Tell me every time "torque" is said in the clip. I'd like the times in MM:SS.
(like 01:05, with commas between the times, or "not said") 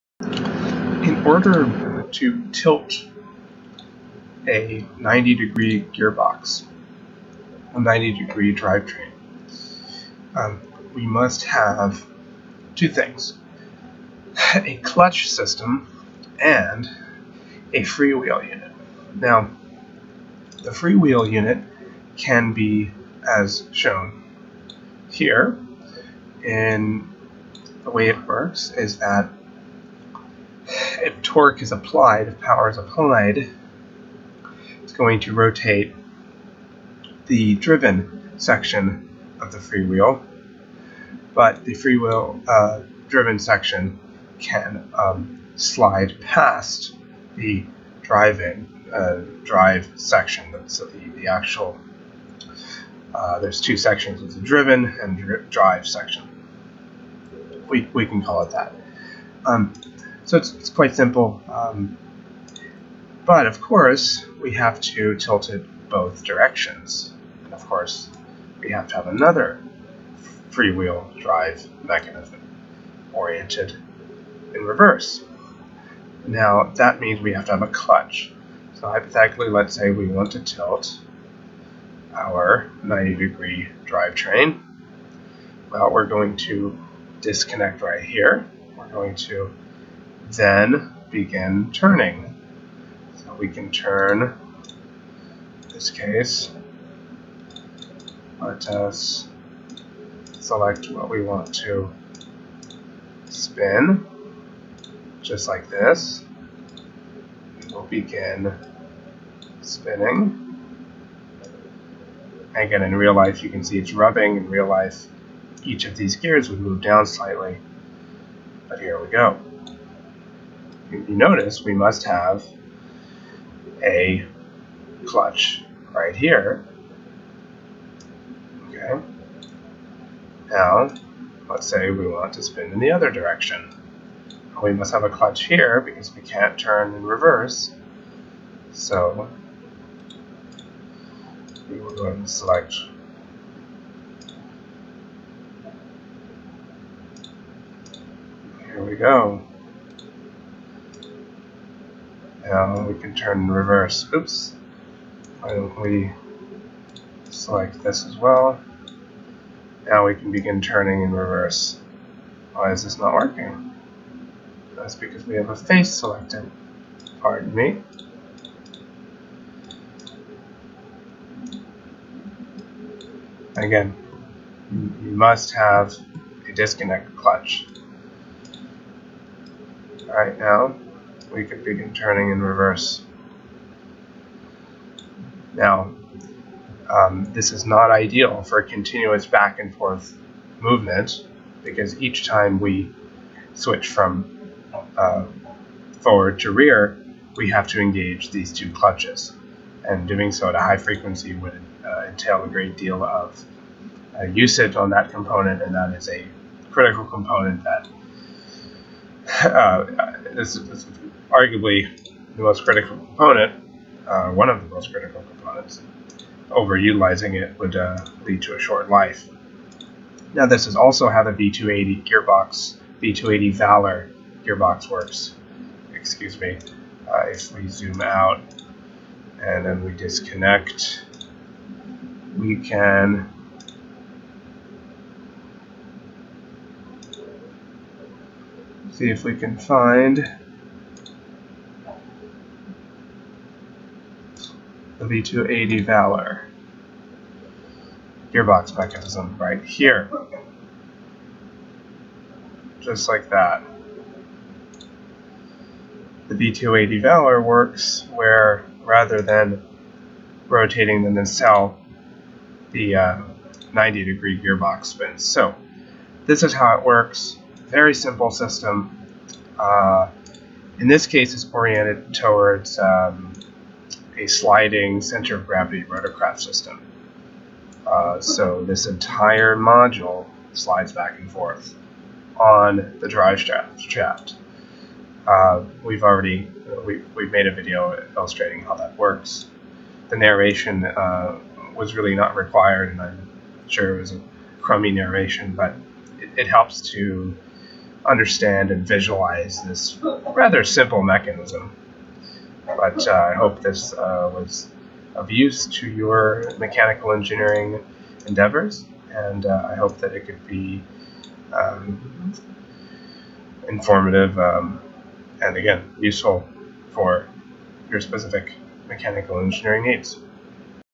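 00:31.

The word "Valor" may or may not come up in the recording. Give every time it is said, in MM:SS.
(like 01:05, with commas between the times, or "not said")
03:43, 04:05, 04:17.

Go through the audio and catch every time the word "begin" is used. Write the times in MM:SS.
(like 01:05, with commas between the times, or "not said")
01:31, 01:47, 02:40, 03:01.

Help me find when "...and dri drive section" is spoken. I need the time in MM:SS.
00:55.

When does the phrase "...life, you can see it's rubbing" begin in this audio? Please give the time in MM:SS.
01:53.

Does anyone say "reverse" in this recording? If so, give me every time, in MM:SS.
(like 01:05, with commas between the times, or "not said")
01:14, 02:17, 02:33, 02:41, 03:02.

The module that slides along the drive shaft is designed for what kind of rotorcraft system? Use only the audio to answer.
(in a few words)
sliding center of gravity.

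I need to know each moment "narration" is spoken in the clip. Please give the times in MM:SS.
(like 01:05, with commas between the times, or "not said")
04:50, 04:54.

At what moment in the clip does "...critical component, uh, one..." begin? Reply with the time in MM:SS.
03:32.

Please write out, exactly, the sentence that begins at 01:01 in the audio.
Um, but of course, we have to tilt it both directions.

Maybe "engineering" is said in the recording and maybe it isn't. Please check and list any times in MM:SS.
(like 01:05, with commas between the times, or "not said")
05:07, 05:19.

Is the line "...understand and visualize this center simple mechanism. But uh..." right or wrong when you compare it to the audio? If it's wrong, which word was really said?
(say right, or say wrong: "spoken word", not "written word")
wrong: "rather", not "center".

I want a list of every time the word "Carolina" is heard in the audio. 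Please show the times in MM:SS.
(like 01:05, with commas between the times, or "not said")
not said.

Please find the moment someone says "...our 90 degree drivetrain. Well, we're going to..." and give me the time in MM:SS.
01:22.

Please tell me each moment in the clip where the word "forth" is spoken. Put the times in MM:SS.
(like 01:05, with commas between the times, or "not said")
03:09, 04:41.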